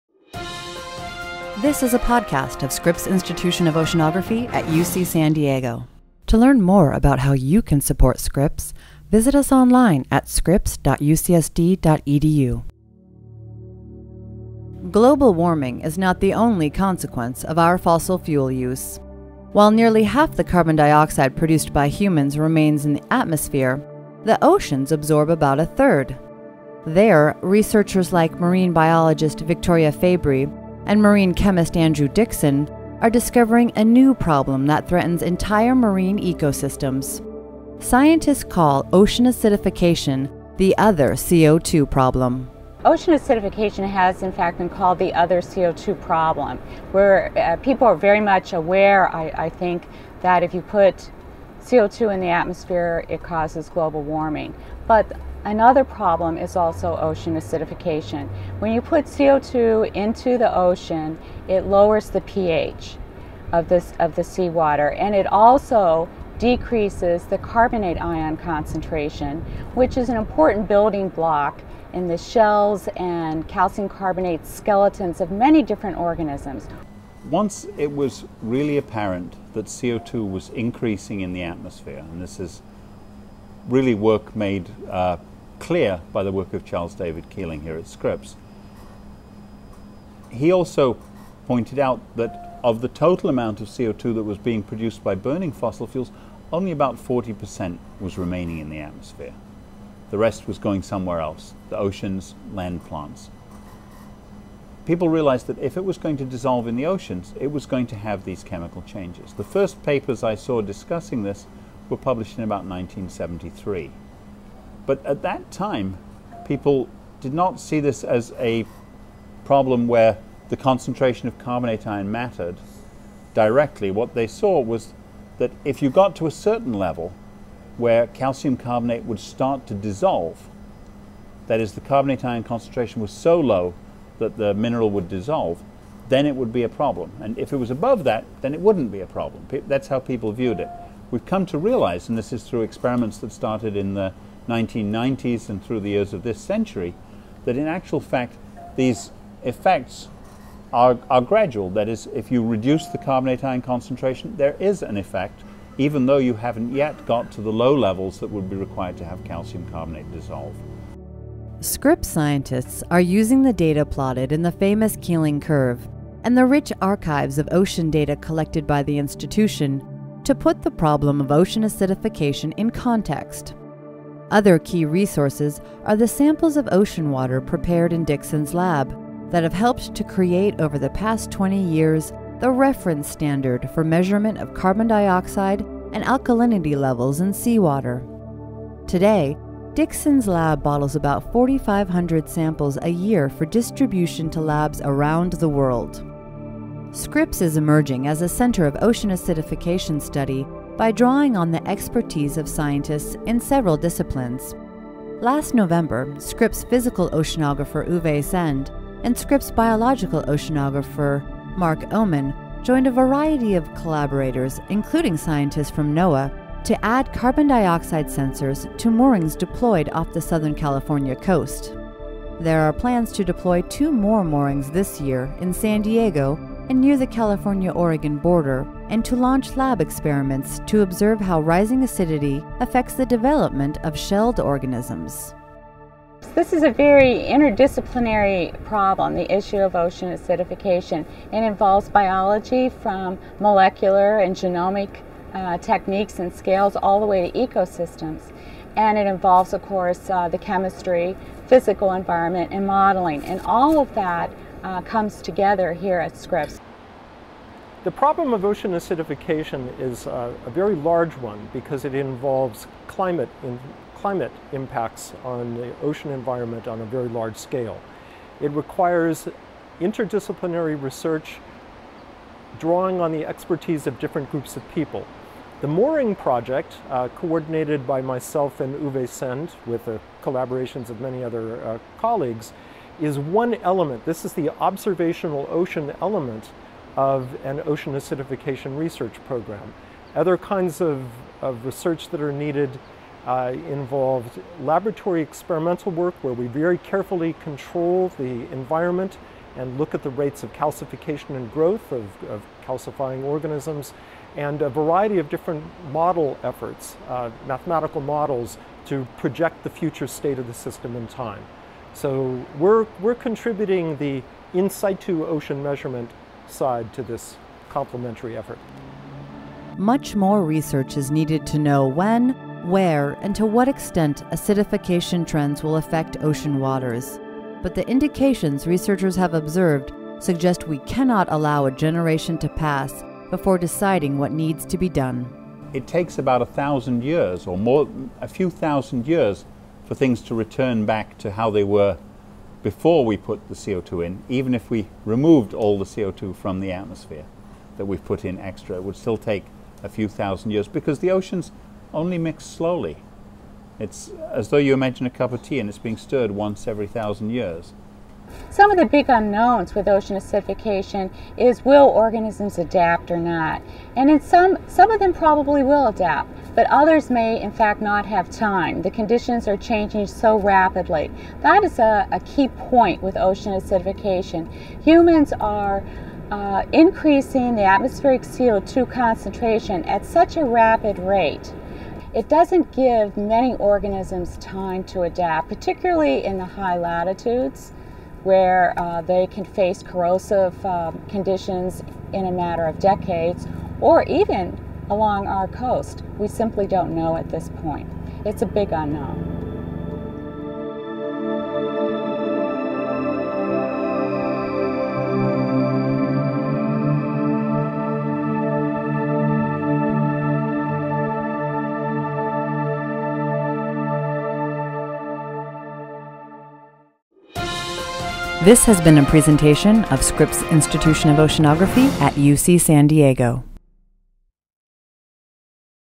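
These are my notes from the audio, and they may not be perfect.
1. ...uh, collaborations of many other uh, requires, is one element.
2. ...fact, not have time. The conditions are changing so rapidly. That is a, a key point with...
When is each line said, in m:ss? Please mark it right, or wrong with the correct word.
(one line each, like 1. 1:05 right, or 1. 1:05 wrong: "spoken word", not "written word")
1. 4:39 wrong: "colleagues", not "requires"
2. 6:07 right.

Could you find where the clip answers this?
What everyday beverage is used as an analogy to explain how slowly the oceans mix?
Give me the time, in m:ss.
5:55.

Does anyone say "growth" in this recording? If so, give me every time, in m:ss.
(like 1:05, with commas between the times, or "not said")
5:01.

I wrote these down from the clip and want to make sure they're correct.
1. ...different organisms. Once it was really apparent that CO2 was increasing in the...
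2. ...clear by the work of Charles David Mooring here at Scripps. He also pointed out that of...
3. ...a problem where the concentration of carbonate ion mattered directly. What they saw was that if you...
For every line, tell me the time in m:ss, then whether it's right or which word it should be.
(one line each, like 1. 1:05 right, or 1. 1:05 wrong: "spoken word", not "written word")
1. 1:15 right
2. 1:25 wrong: "Keeling", not "Mooring"
3. 1:58 right.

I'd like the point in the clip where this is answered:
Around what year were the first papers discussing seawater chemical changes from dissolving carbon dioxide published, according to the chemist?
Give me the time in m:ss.
1:52.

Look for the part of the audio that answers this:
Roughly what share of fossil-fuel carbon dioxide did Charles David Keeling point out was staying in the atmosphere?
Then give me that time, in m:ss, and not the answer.
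1:36.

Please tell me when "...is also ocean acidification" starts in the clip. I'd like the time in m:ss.
0:56.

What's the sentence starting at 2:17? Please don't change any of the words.
And if it was above that, then it wouldn't be a problem.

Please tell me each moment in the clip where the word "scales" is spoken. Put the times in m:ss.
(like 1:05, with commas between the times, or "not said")
4:06, 4:27.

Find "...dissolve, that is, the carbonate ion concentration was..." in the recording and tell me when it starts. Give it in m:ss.
2:09.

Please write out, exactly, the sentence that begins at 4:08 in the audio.
And it involves, of course, uh, the chemistry, physical environment, and modeling.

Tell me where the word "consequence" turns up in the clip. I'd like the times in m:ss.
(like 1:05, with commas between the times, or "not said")
0:16.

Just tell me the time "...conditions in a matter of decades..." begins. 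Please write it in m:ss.
6:31.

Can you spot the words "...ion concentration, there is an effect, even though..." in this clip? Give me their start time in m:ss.
2:33.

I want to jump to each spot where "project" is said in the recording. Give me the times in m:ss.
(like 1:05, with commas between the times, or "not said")
4:36, 5:09.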